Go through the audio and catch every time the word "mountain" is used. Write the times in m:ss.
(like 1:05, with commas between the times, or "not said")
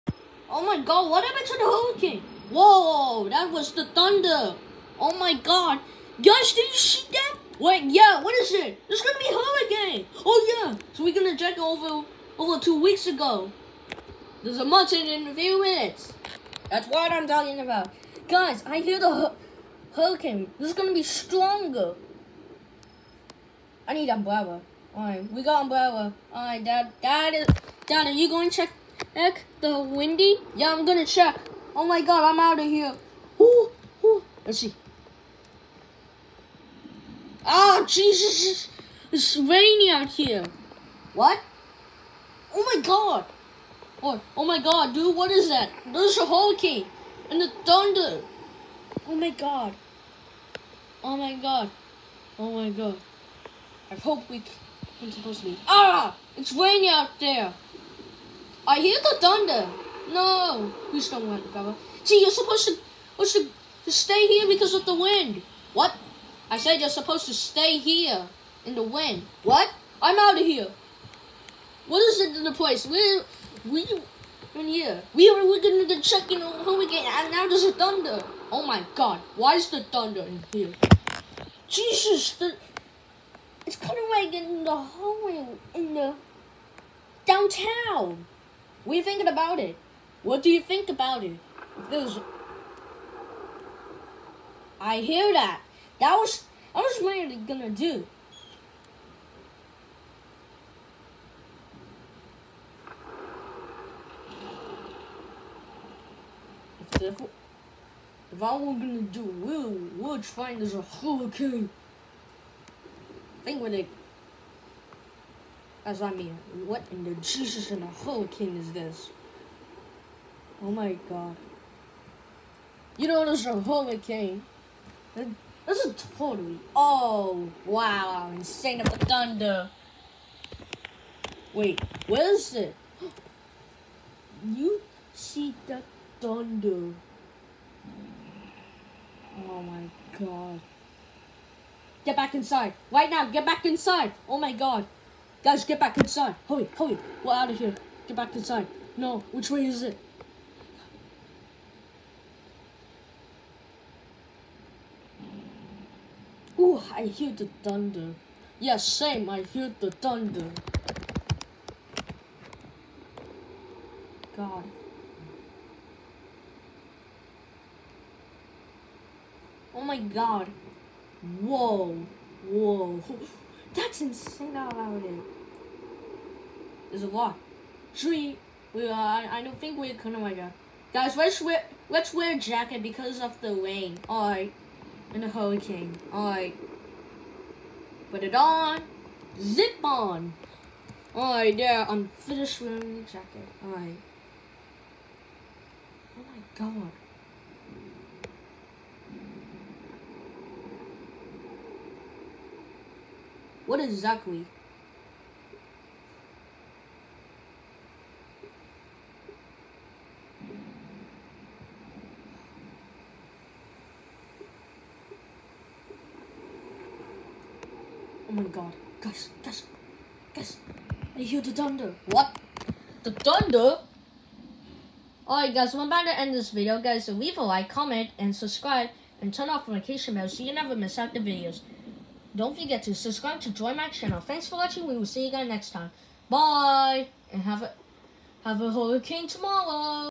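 0:14.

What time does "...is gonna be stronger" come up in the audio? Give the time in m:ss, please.
0:20.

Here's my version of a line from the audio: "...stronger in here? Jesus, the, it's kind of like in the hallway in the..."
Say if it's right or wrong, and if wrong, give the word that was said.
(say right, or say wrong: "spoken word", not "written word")
wrong: "thunder", not "stronger".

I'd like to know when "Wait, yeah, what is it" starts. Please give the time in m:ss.
0:07.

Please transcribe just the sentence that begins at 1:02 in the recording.
See, you're supposed to, supposed to, to stay here because of the wind.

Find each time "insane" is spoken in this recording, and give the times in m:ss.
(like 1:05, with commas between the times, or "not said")
2:08, 2:54.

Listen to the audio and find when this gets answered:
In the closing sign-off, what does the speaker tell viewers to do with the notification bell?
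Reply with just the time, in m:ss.
3:49.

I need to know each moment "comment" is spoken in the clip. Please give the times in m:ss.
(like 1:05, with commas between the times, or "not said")
3:47.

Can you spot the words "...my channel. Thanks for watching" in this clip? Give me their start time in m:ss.
3:53.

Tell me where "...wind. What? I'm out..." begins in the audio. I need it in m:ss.
1:08.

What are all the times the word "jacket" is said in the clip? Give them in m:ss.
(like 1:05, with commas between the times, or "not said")
3:02, 3:13.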